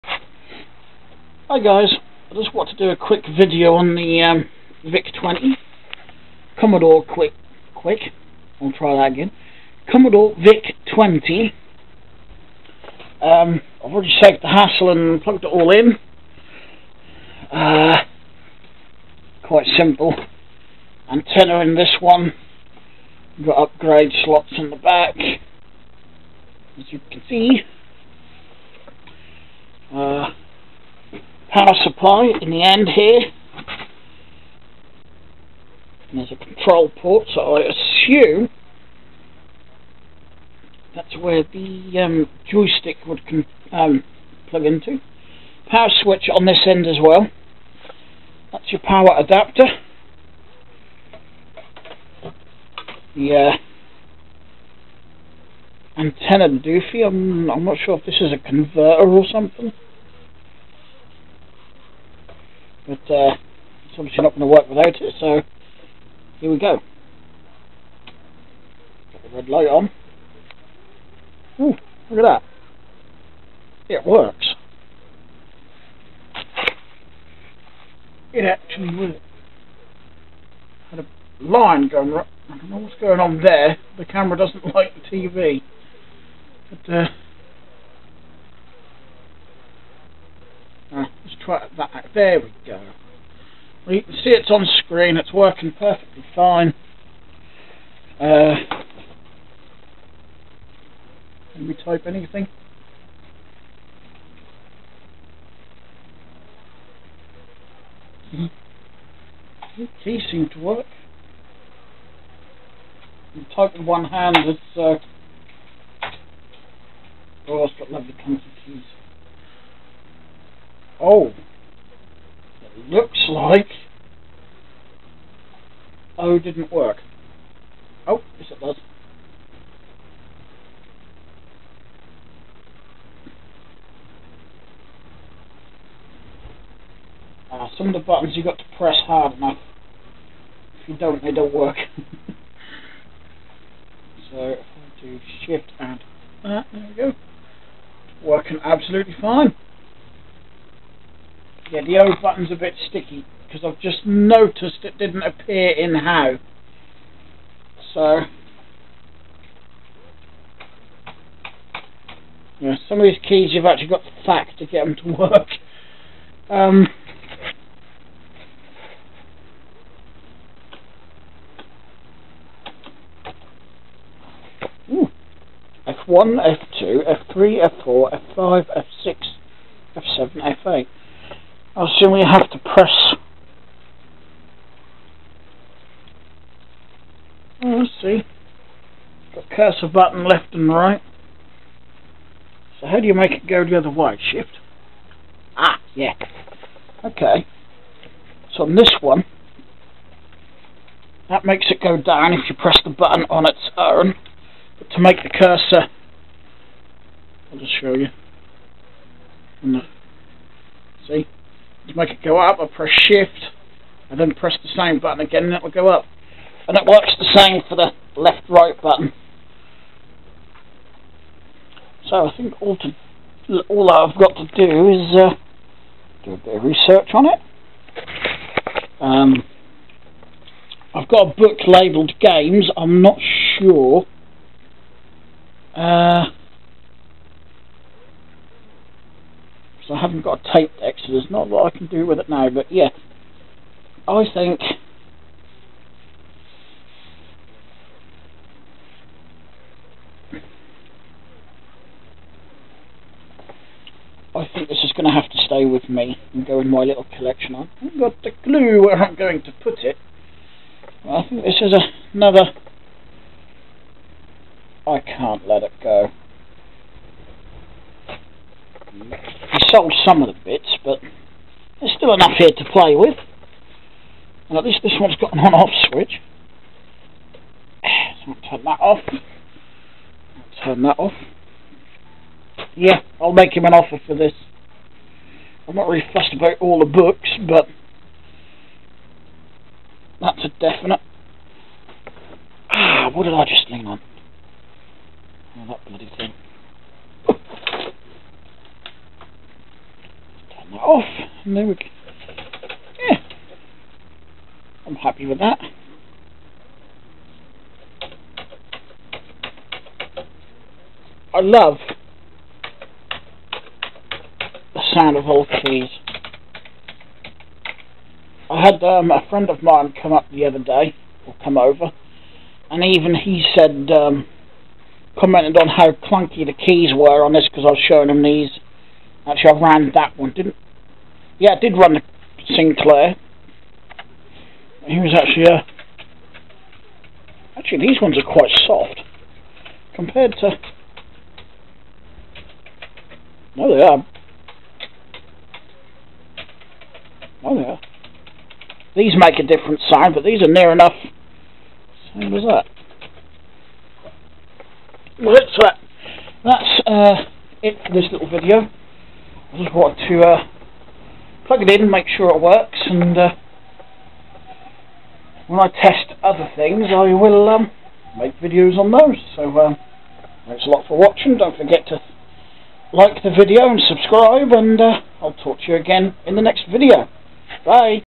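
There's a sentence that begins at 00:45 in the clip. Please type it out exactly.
Power switch on this end as well.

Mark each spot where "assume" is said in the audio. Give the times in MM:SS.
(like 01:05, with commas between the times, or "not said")
00:37, 03:01.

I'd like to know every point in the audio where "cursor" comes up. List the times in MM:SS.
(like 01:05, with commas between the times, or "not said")
03:09, 03:25.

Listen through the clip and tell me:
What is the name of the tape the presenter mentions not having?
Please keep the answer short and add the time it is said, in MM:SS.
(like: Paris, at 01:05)
Exodus, at 04:00.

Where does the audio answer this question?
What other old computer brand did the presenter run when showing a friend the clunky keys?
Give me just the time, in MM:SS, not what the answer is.
05:32.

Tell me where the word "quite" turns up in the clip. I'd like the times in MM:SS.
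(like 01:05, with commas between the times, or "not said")
00:19, 05:38.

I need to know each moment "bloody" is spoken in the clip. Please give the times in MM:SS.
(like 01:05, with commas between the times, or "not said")
04:55.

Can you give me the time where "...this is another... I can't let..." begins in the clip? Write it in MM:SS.
04:21.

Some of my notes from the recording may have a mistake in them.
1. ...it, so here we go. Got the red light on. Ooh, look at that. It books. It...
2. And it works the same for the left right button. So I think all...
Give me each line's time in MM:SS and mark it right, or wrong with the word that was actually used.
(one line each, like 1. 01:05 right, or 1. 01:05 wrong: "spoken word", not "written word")
1. 01:05 wrong: "works", not "books"
2. 03:36 right.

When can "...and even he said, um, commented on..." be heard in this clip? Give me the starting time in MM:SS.
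05:22.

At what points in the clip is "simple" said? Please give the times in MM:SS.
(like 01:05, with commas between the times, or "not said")
00:19.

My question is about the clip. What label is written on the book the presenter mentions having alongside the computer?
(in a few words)
Games.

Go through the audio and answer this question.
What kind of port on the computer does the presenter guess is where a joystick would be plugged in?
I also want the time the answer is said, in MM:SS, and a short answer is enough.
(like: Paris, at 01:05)
Control port, at 00:36.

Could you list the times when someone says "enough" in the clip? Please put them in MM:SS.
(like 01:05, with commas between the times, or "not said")
02:19, 04:32, 05:50.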